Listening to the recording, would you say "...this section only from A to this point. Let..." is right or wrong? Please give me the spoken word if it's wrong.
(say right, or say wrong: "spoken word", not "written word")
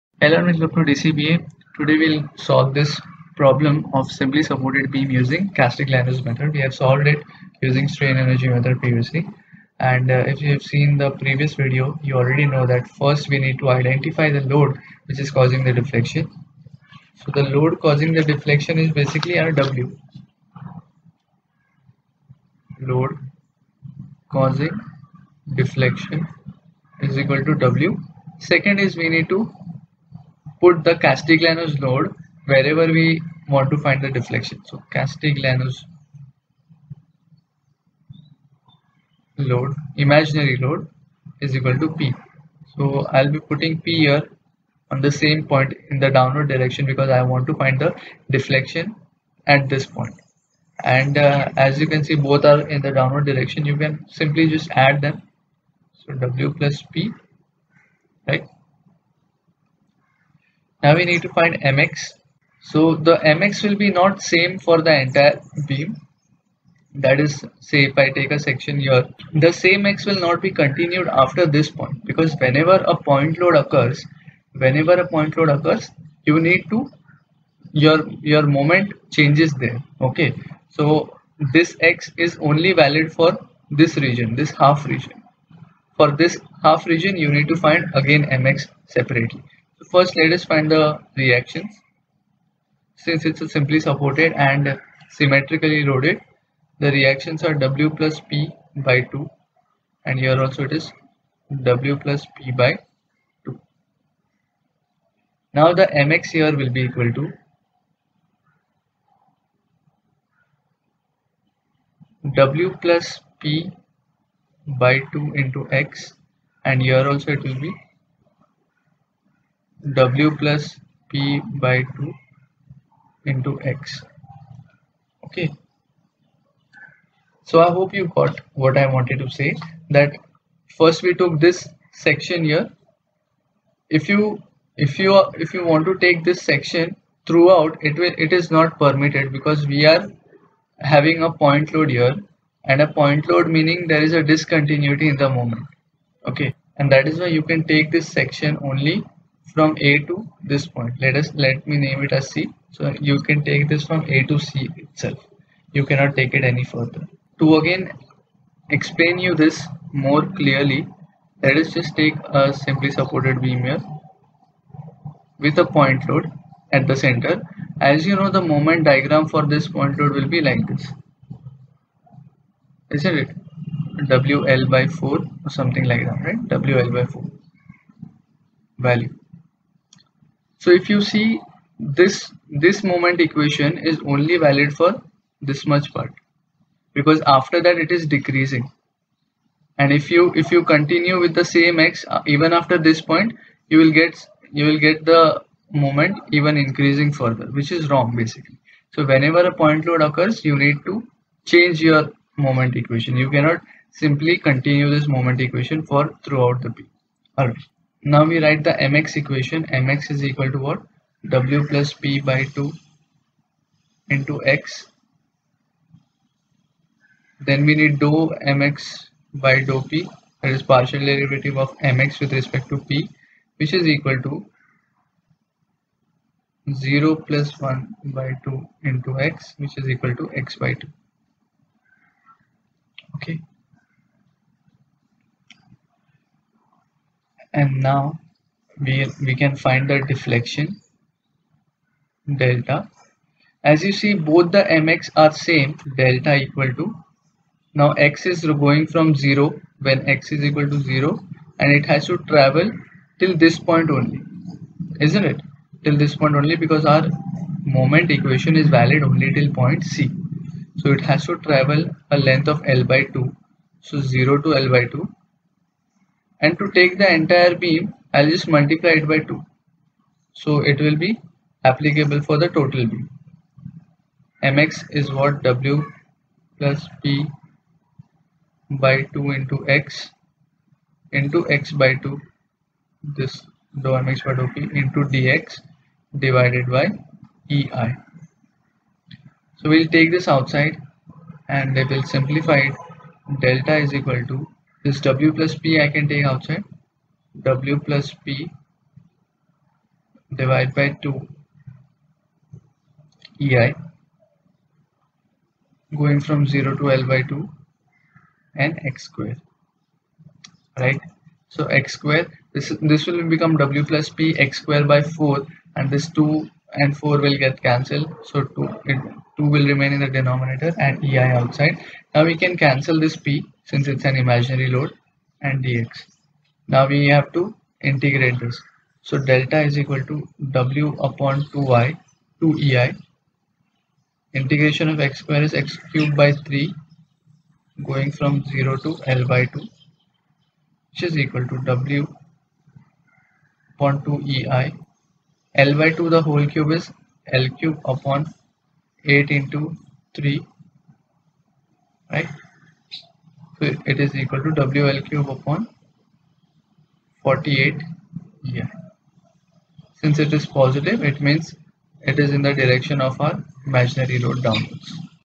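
right.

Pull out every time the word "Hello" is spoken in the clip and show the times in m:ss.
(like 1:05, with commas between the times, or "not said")
0:00.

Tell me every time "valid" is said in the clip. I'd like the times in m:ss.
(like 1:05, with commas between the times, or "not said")
1:22, 3:04, 4:18.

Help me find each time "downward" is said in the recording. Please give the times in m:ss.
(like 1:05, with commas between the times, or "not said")
0:46, 0:52, 6:04.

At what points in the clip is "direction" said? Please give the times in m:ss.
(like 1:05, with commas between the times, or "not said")
0:46, 0:53, 6:02.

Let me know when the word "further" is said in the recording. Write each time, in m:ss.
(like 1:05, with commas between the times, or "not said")
2:36, 3:17.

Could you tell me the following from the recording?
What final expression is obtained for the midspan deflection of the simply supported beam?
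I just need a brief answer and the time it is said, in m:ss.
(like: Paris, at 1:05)
WL³/48EI, at 5:54.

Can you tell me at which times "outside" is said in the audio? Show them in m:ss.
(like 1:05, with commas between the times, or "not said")
4:50, 4:56, 5:21.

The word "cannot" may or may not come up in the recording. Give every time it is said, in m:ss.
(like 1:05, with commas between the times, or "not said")
2:35, 3:23.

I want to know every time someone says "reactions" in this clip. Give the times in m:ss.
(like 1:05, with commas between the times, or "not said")
1:31, 1:36.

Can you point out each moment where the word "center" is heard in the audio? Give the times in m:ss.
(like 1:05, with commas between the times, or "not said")
2:46.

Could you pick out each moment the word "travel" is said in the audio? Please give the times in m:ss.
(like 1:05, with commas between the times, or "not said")
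4:12, 4:21.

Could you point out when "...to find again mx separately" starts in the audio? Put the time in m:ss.
1:27.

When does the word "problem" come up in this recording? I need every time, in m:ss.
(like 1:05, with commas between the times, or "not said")
0:03.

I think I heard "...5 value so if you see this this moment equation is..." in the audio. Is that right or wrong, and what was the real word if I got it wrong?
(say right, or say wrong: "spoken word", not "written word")
wrong: "4", not "5".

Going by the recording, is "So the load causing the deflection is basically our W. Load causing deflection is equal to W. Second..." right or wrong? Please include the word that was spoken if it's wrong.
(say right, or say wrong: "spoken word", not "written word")
right.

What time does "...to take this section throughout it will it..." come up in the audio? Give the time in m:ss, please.
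2:15.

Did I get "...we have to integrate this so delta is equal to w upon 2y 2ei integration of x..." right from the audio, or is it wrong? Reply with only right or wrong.
right.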